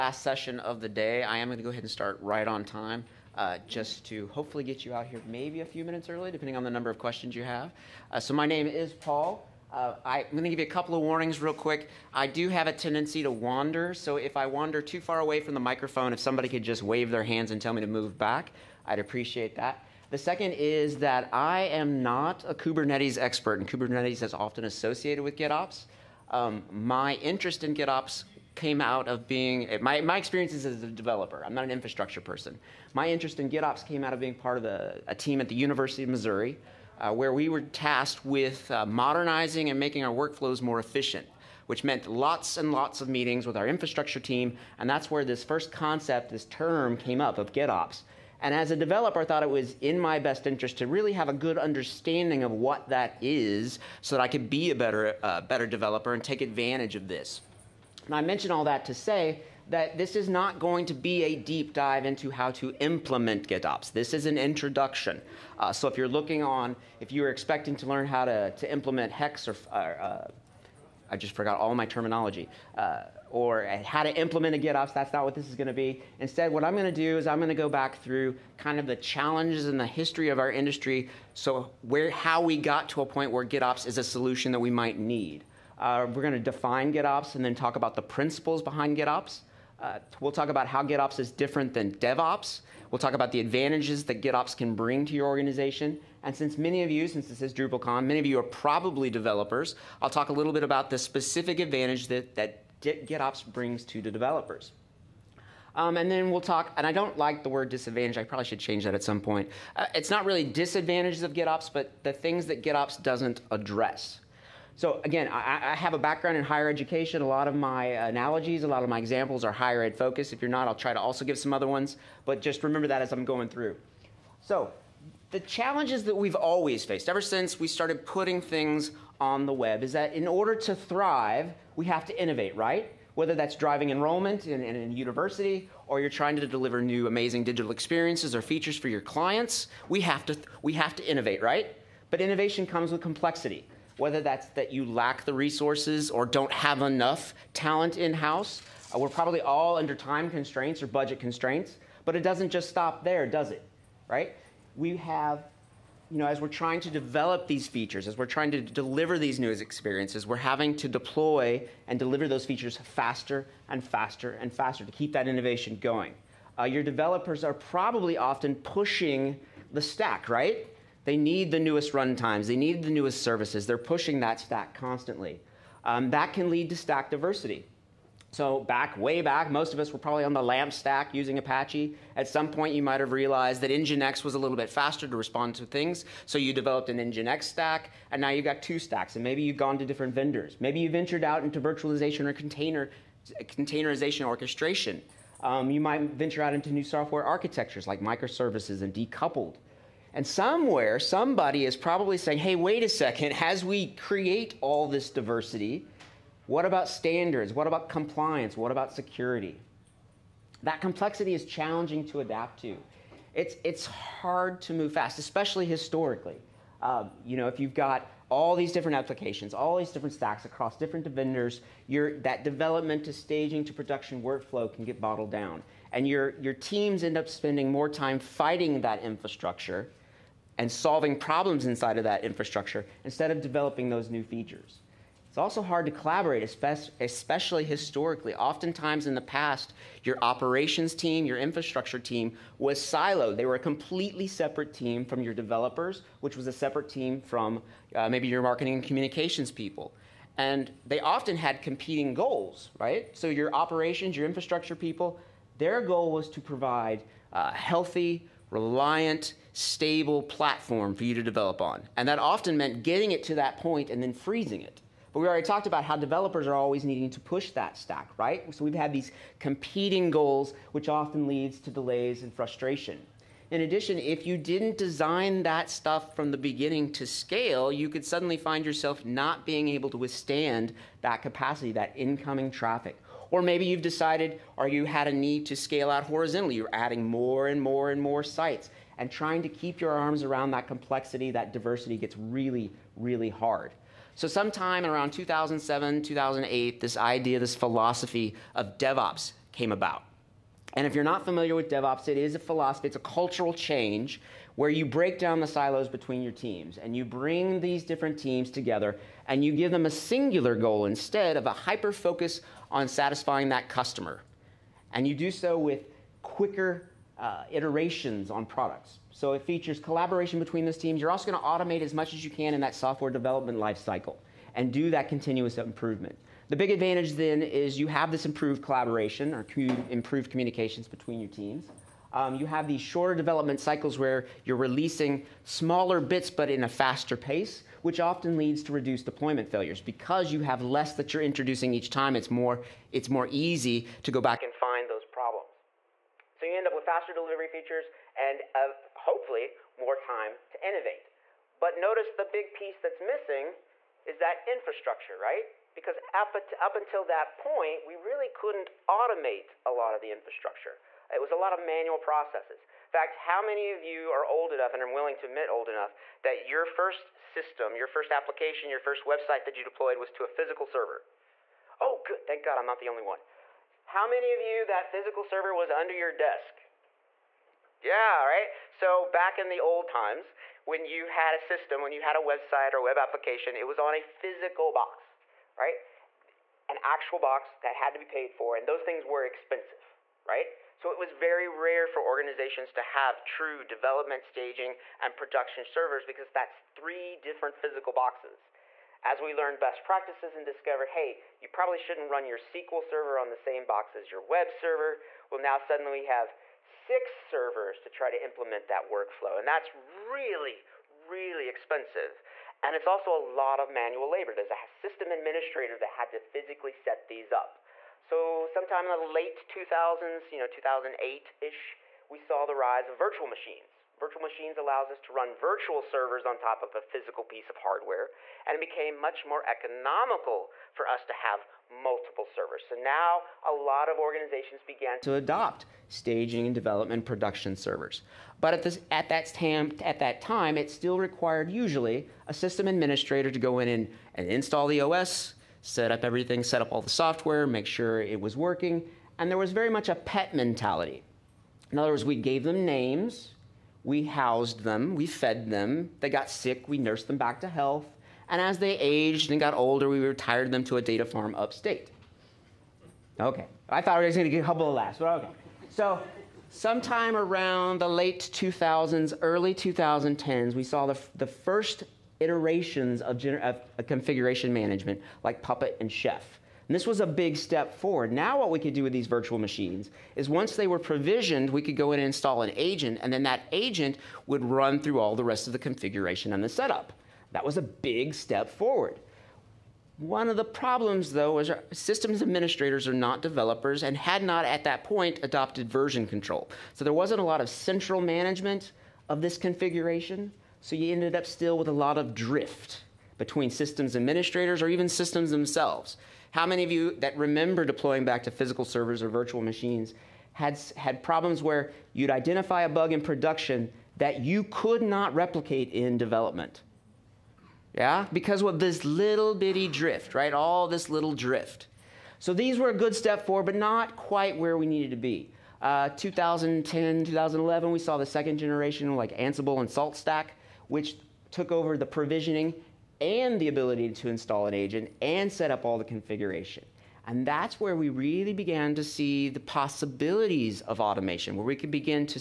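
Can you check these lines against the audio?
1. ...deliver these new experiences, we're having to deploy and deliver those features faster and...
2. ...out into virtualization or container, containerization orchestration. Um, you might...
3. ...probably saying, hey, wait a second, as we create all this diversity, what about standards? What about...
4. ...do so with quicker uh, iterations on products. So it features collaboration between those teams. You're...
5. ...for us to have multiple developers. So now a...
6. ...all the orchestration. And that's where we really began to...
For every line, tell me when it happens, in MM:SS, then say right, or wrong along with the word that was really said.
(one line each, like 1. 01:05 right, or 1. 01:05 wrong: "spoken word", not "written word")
1. 02:38 right
2. 03:11 right
3. 03:21 right
4. 05:15 right
5. 07:10 wrong: "servers", not "developers"
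6. 08:55 wrong: "configuration", not "orchestration".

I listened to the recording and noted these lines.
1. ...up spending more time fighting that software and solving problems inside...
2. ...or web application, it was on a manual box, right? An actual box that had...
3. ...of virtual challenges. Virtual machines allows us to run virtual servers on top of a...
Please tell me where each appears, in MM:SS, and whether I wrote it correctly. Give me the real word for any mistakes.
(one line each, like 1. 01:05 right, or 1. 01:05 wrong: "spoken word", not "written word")
1. 03:47 wrong: "infrastructure", not "software"
2. 06:22 wrong: "physical", not "manual"
3. 07:02 wrong: "machines", not "challenges".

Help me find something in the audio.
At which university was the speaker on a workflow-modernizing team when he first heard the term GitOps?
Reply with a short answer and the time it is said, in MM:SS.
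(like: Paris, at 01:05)
University of Missouri, at 00:35.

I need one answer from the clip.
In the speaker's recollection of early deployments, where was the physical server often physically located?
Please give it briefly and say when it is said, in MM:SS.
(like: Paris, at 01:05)
under your desk, at 06:15.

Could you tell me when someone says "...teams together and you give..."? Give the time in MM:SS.
05:08.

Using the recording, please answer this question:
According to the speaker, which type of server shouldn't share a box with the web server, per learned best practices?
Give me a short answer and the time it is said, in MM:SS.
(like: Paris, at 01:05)
SQL server, at 06:42.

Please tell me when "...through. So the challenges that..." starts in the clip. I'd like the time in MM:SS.
02:03.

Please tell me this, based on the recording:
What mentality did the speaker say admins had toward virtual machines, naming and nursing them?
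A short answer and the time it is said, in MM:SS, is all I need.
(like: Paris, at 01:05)
pet mentality, at 07:29.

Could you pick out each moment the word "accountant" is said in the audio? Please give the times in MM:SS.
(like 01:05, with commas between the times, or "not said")
not said.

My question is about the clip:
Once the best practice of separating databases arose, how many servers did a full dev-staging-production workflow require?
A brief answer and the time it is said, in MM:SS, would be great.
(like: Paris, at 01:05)
6, at 06:46.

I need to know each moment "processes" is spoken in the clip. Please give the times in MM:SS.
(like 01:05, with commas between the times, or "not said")
06:01.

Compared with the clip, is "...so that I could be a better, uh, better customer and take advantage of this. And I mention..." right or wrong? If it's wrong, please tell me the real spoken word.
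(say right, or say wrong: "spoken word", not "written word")
wrong: "developer", not "customer".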